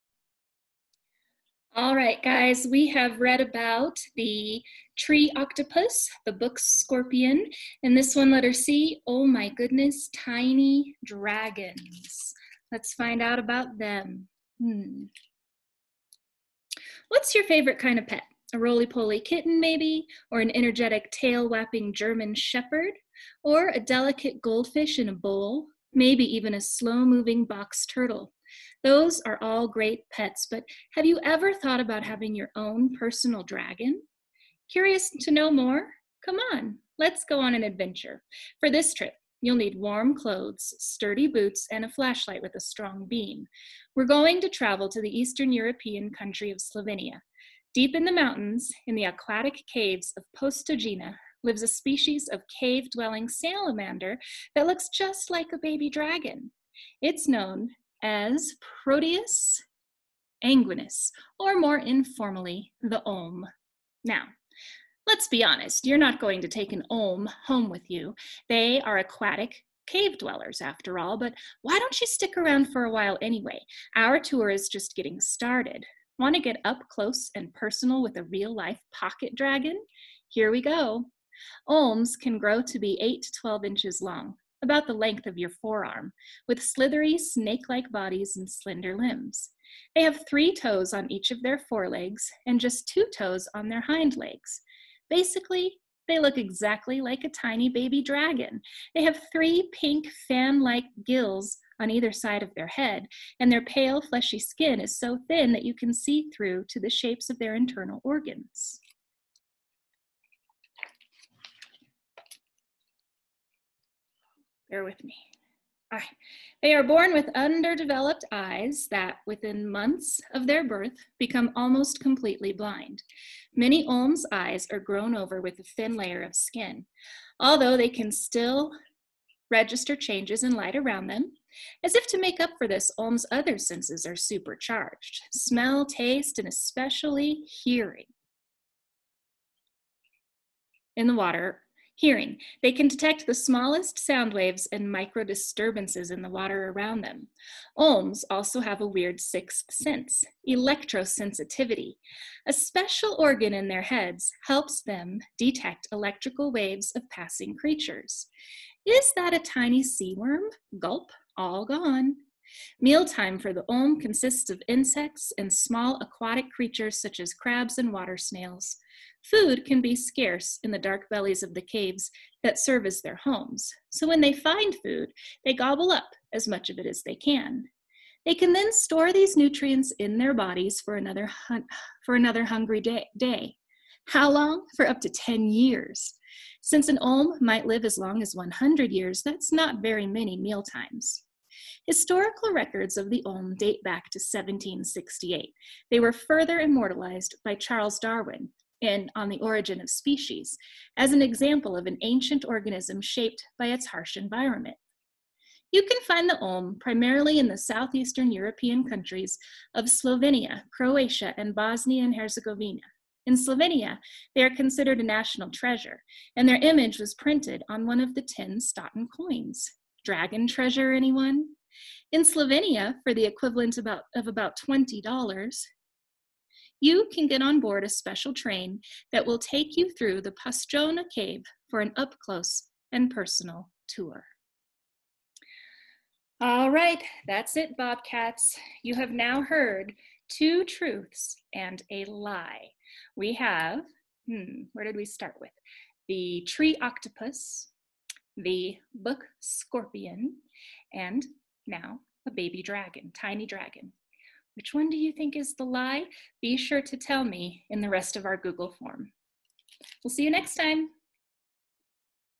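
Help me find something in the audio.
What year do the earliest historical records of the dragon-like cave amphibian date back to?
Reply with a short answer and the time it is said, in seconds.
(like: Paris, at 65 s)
1768, at 194 s.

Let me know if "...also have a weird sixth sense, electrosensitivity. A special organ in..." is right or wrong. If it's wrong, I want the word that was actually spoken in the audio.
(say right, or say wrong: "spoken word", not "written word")
right.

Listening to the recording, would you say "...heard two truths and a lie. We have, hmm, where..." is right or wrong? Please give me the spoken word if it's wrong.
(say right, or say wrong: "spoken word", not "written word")
right.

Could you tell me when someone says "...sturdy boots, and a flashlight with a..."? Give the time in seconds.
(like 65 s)
40 s.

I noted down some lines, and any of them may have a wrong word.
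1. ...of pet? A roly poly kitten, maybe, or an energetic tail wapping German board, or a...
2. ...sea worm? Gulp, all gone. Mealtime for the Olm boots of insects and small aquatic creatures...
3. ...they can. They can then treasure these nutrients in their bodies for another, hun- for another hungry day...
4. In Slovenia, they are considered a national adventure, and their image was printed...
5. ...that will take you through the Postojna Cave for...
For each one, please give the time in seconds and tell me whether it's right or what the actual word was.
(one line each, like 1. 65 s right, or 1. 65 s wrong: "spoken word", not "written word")
1. 17 s wrong: "shepherd", not "board"
2. 159 s wrong: "consists", not "boots"
3. 177 s wrong: "store", not "treasure"
4. 213 s wrong: "treasure", not "adventure"
5. 229 s right.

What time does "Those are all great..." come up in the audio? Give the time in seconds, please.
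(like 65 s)
28 s.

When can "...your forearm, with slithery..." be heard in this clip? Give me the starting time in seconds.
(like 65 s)
85 s.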